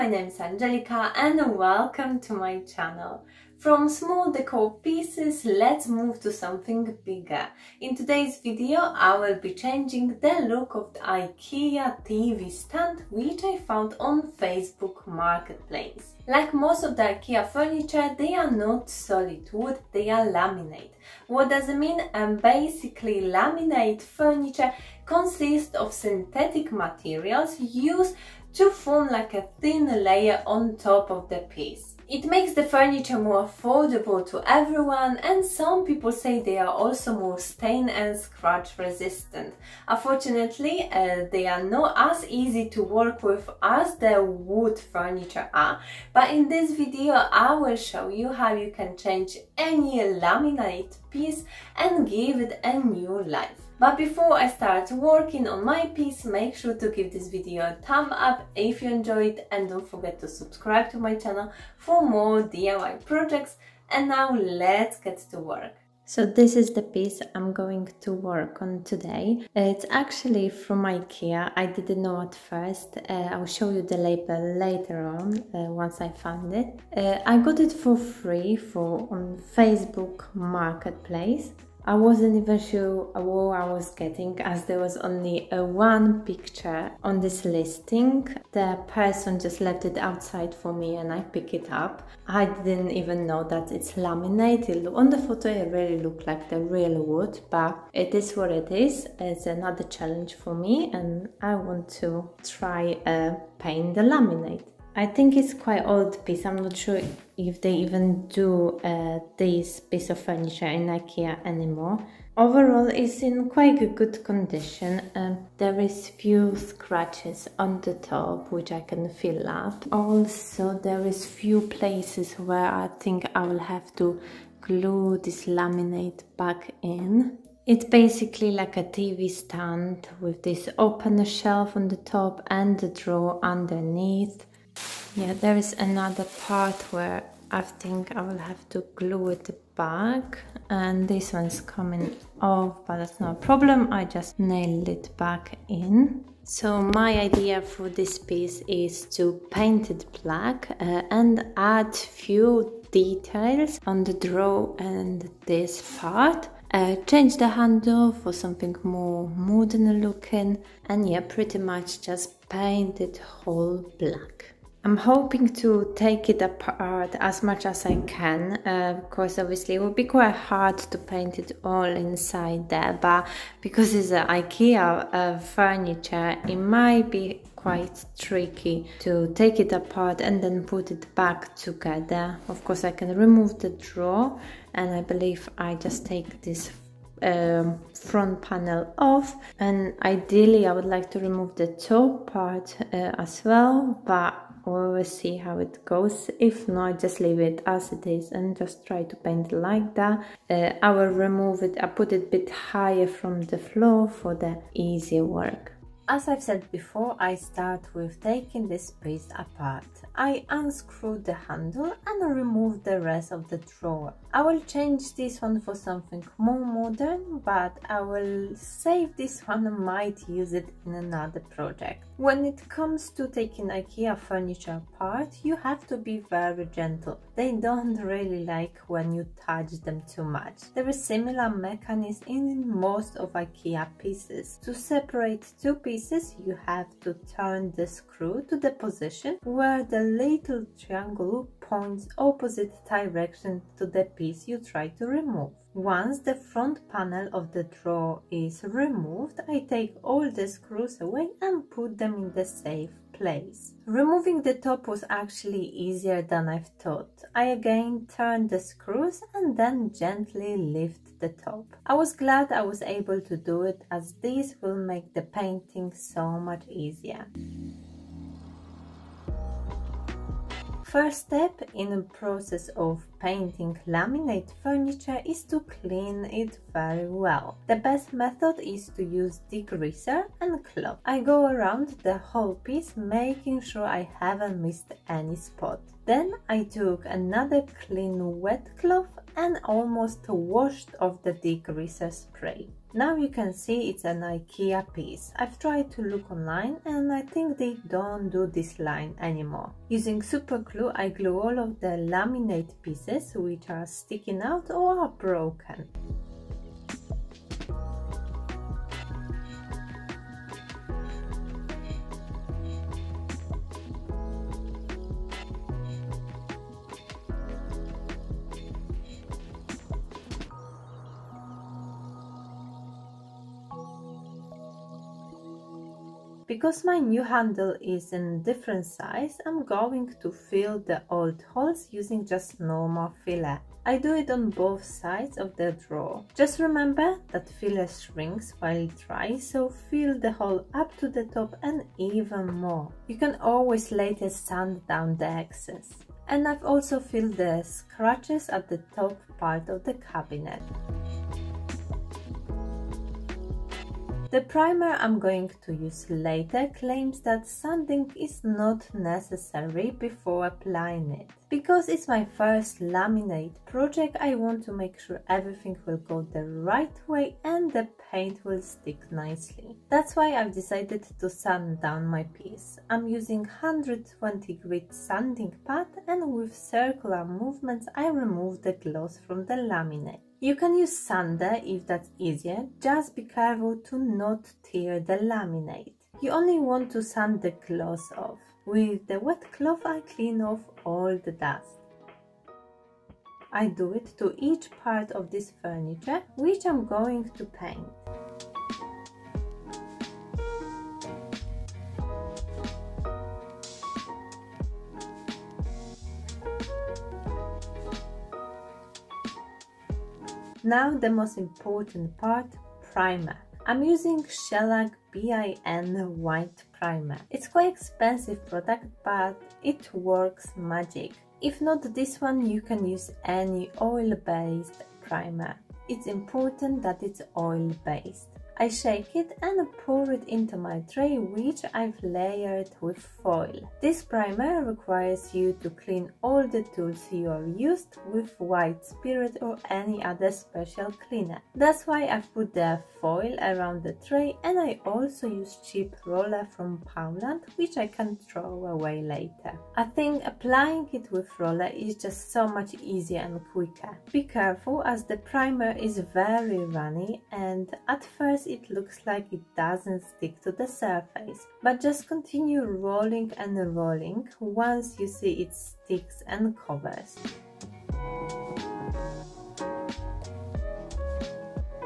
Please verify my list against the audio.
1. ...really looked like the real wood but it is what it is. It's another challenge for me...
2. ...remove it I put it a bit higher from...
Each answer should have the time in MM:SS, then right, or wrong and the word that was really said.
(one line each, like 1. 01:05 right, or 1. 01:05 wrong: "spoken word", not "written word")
1. 01:35 right
2. 03:21 right.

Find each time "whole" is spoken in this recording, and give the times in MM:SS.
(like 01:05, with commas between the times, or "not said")
02:43, 04:42.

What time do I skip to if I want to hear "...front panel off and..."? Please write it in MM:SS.
03:07.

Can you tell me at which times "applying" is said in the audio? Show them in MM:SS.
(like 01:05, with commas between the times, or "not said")
06:00, 07:30.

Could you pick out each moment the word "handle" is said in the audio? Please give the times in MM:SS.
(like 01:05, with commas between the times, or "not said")
02:37, 03:31, 05:27.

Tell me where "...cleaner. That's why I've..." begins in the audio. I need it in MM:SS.
07:21.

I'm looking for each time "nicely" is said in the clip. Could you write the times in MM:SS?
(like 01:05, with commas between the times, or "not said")
06:09.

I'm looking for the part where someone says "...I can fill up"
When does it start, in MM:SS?
01:58.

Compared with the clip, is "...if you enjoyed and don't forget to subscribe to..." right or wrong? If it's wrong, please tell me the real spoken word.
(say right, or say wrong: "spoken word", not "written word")
right.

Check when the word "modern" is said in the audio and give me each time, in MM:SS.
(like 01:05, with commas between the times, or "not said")
02:39, 03:36.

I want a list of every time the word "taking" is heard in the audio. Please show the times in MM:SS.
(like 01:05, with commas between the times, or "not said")
03:28, 03:43.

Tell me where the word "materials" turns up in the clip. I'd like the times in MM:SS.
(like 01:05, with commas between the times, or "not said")
00:26.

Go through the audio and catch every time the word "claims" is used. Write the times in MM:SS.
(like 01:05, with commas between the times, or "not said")
05:56.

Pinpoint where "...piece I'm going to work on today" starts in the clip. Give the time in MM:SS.
01:06.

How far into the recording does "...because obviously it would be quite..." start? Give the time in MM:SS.
02:49.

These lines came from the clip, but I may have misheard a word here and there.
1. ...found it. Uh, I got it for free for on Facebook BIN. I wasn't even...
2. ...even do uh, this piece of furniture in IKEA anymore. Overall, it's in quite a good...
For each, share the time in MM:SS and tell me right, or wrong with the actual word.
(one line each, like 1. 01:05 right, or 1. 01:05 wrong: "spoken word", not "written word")
1. 01:16 wrong: "Marketplace", not "BIN"
2. 01:47 right.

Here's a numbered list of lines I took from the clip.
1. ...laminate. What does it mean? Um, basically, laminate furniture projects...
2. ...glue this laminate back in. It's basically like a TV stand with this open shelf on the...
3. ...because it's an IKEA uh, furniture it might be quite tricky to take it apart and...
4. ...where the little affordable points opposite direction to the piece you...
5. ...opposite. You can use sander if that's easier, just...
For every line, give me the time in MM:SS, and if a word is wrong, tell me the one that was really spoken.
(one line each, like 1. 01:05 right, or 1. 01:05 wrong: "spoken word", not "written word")
1. 00:20 wrong: "consists", not "projects"
2. 02:04 right
3. 02:53 right
4. 03:59 wrong: "triangle", not "affordable"
5. 06:19 wrong: "laminate", not "opposite".